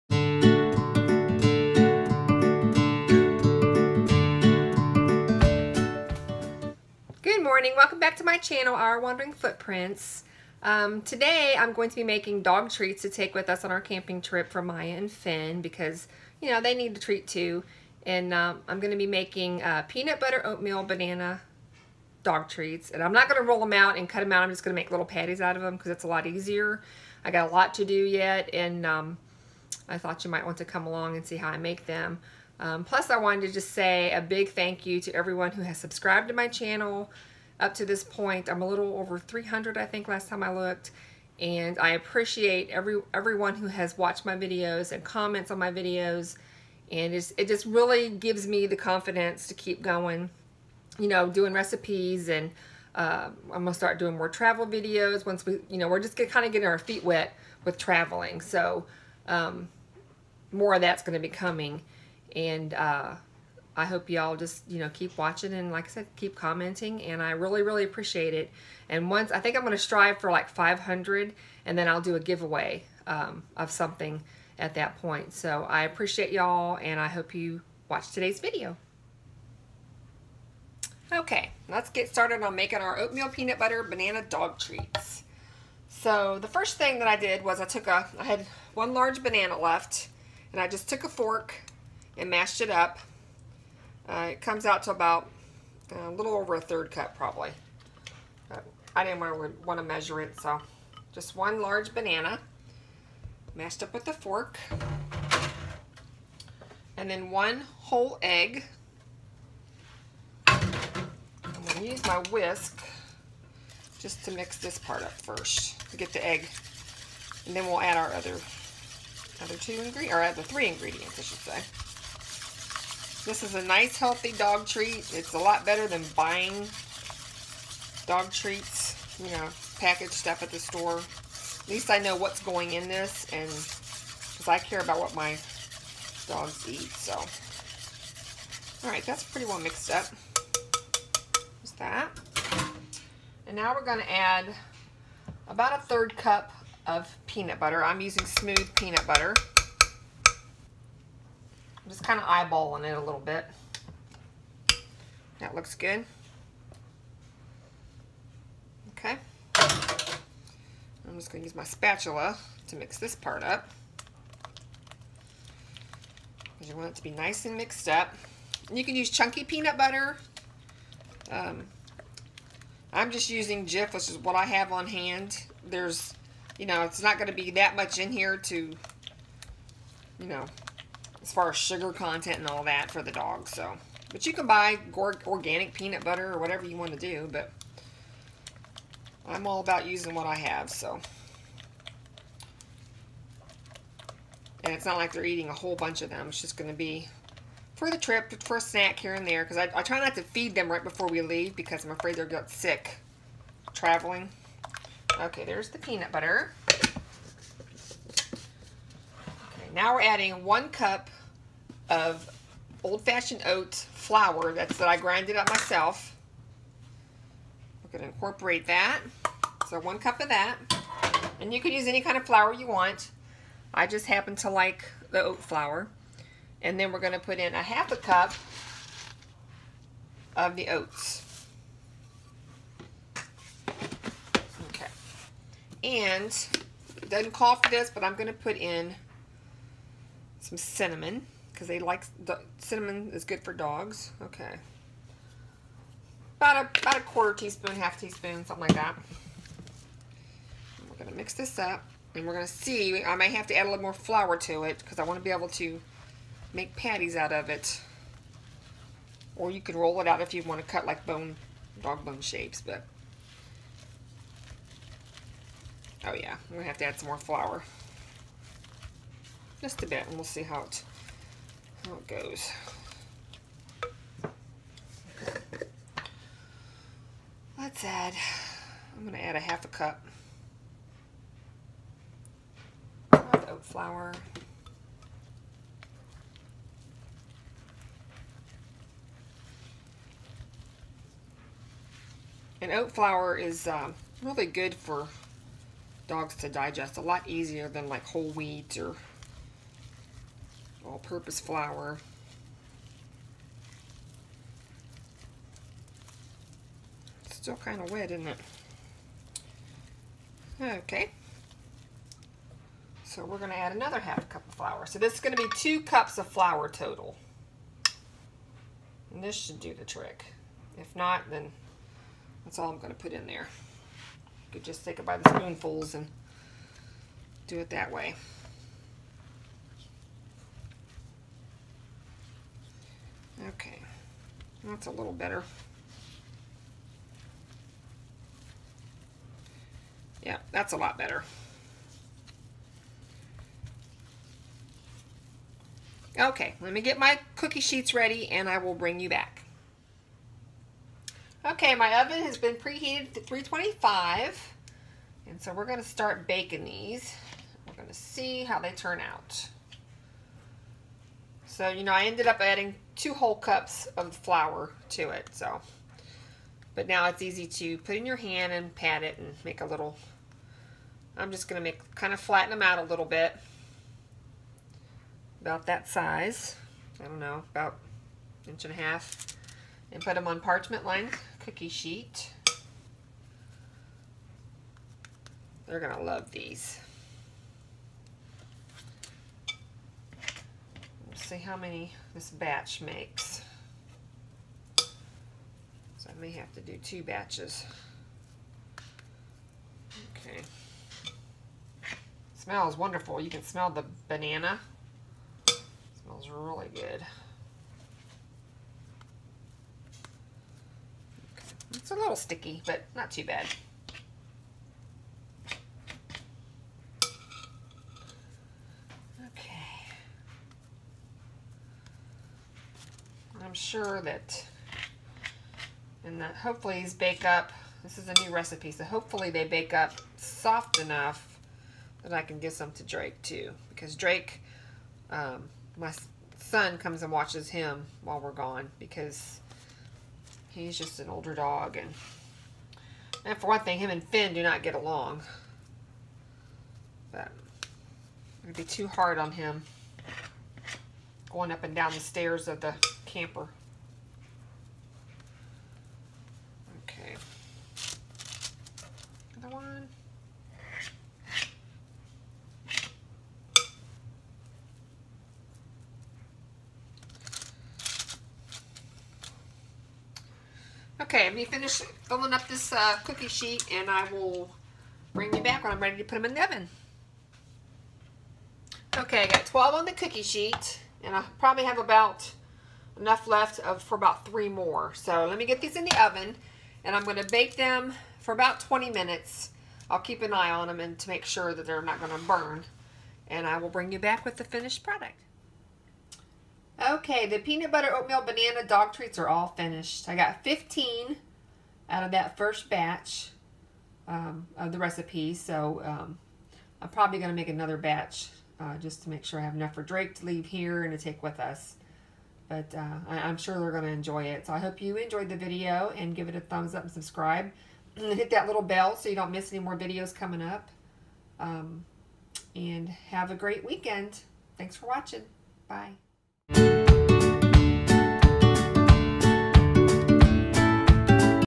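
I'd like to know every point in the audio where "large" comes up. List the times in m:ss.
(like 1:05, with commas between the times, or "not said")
1:28, 1:41.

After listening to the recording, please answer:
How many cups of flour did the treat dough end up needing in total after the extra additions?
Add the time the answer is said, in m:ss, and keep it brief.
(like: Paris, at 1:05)
2, at 5:15.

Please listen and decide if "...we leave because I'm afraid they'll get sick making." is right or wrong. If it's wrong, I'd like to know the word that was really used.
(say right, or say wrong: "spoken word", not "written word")
wrong: "traveling", not "making".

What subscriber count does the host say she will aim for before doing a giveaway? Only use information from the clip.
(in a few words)
500.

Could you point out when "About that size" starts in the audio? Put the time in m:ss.
6:15.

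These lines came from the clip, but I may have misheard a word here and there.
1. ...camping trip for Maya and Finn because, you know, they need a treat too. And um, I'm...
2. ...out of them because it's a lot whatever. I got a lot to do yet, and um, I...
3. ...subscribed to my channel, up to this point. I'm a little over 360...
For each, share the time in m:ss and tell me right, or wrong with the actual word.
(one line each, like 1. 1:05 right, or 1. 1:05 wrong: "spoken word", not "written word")
1. 0:13 right
2. 0:25 wrong: "easier", not "whatever"
3. 0:35 wrong: "300", not "360".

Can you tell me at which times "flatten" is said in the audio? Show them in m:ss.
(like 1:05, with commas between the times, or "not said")
6:12.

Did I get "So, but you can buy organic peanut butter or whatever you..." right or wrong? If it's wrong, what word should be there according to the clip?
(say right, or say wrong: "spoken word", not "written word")
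right.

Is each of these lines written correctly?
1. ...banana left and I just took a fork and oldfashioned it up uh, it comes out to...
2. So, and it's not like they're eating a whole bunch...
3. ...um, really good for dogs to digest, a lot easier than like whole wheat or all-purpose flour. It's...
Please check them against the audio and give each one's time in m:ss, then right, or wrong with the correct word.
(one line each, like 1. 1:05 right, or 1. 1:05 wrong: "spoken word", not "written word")
1. 1:29 wrong: "mashed", not "oldfashioned"
2. 3:10 right
3. 4:53 right.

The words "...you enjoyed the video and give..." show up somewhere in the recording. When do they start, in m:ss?
8:34.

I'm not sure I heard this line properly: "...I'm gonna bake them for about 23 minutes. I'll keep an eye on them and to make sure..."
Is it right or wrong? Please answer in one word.
wrong.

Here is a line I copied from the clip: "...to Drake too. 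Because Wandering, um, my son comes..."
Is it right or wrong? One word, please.
wrong.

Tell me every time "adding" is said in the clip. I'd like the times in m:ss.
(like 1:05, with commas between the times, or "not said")
3:30, 6:02.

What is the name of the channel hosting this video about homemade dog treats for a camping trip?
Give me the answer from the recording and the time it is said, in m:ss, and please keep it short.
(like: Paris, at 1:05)
Our Wandering Footprints, at 0:08.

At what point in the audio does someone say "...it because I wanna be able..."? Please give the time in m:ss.
4:14.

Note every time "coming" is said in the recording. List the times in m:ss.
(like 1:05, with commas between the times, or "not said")
1:01, 8:40.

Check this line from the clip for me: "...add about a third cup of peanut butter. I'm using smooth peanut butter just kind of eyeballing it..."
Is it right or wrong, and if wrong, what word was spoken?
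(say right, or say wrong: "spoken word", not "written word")
right.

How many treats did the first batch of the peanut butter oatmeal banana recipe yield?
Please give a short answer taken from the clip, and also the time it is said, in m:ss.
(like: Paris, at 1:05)
15, at 8:20.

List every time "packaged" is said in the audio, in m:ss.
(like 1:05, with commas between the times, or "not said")
2:09.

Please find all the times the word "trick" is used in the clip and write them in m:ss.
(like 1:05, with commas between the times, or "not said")
5:19.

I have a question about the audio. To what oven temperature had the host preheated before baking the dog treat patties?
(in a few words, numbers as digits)
325.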